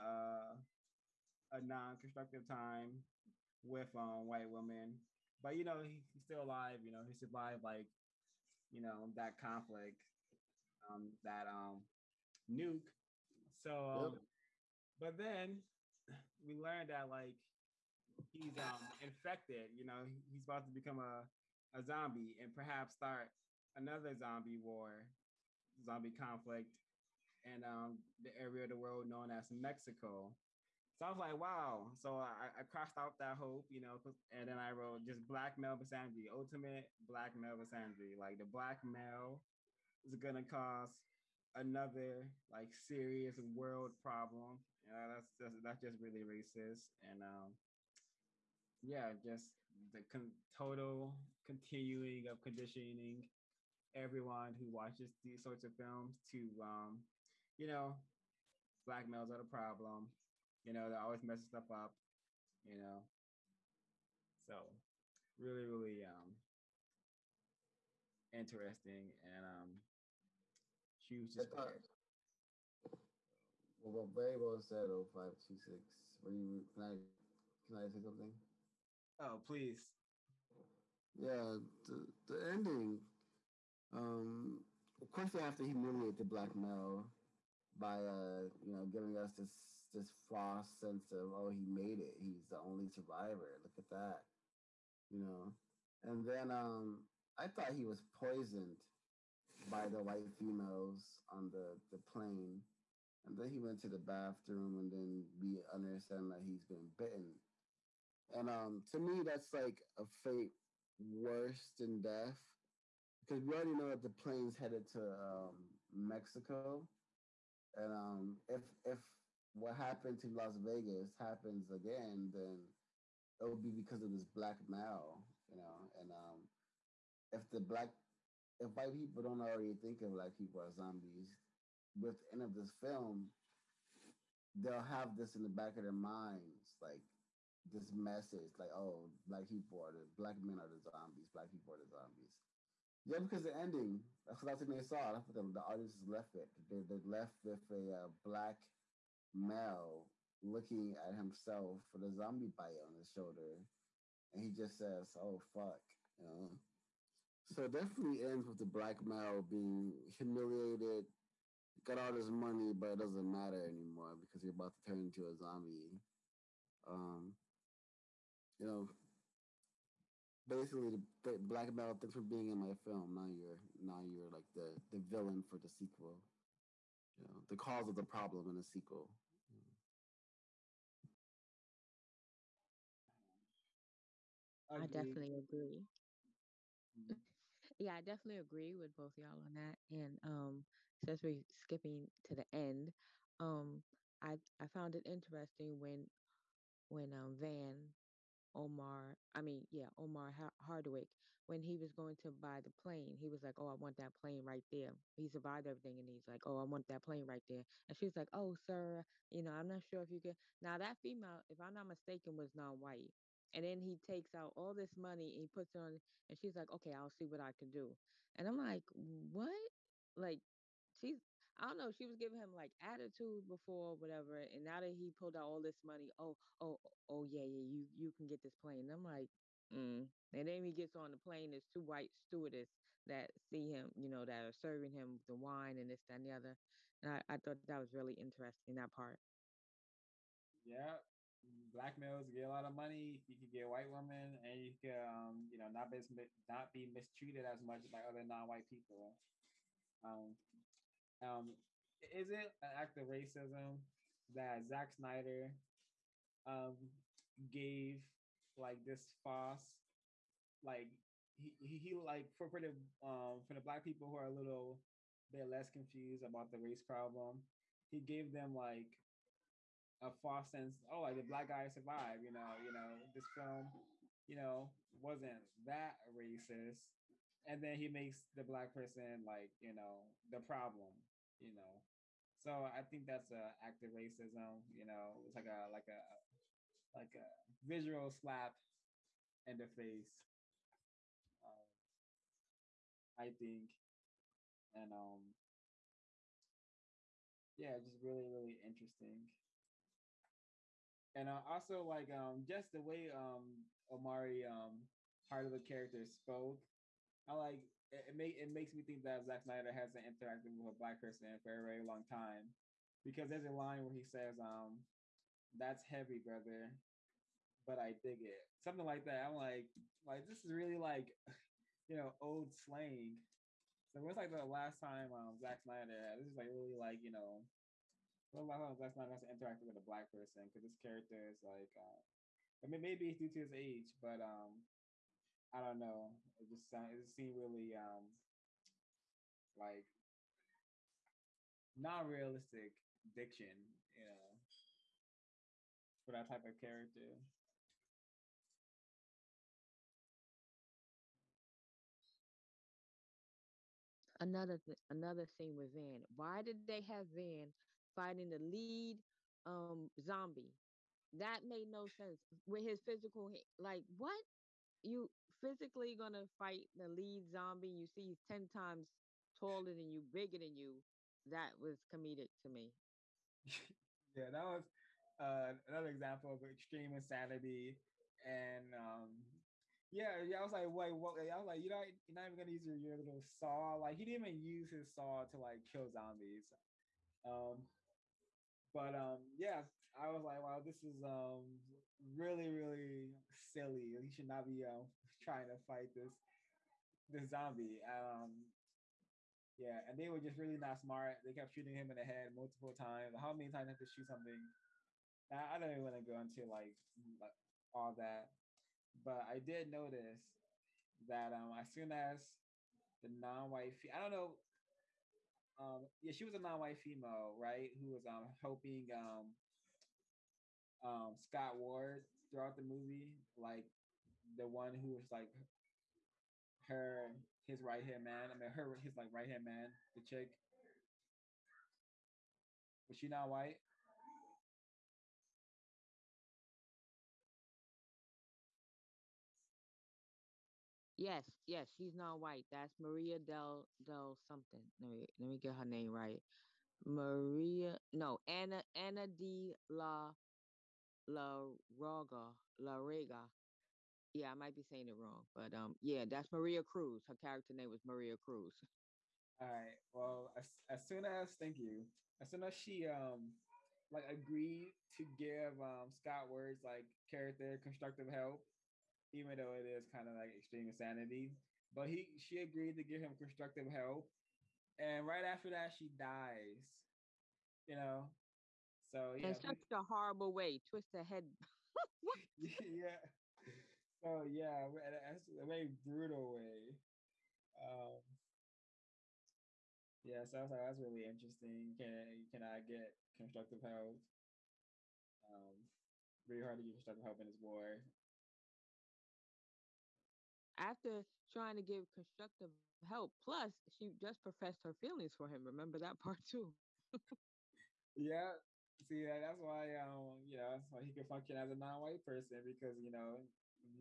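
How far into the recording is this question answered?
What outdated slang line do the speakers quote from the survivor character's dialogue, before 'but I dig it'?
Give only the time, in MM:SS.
05:15.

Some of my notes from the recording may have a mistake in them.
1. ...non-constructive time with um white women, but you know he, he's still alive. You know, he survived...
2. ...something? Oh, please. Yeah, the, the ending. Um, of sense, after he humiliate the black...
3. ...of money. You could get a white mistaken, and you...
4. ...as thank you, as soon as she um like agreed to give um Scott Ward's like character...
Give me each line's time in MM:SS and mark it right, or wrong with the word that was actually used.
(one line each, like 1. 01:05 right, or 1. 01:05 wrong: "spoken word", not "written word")
1. 00:01 right
2. 01:18 wrong: "course", not "sense"
3. 04:02 wrong: "women", not "mistaken"
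4. 07:41 right.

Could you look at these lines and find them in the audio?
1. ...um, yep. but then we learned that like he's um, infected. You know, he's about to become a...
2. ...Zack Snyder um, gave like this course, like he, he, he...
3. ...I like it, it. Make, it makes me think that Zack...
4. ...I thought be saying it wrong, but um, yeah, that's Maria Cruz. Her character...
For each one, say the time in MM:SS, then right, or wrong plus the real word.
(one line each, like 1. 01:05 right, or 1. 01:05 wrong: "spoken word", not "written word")
1. 00:13 right
2. 04:14 wrong: "false", not "course"
3. 05:07 right
4. 07:34 wrong: "might", not "thought".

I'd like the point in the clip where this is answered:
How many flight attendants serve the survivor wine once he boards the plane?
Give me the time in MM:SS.
03:51.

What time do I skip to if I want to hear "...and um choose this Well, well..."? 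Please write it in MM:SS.
01:09.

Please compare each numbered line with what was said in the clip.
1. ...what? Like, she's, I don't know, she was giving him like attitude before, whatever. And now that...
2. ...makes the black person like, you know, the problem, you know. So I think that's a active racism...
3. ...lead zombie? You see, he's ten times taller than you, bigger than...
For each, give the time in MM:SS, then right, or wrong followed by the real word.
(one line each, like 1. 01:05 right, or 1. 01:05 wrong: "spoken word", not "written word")
1. 03:38 right
2. 04:37 right
3. 06:06 right.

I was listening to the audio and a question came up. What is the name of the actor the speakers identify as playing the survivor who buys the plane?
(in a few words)
Omari Hardwick.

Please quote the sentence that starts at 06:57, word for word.
Who was um, helping um, um, Scott Ward throughout the movie, like the one who was like her his right hand man.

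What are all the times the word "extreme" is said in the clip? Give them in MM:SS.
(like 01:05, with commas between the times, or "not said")
06:16, 07:50.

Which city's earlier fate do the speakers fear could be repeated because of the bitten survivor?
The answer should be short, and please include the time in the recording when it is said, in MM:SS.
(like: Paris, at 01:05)
Las Vegas, at 02:00.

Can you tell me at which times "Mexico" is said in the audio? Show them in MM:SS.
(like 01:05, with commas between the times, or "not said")
00:29, 01:55.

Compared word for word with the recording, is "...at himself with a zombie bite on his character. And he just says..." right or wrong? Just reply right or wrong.
wrong.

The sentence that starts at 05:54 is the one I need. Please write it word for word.
Another th- another thing with Van.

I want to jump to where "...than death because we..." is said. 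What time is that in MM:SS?
01:51.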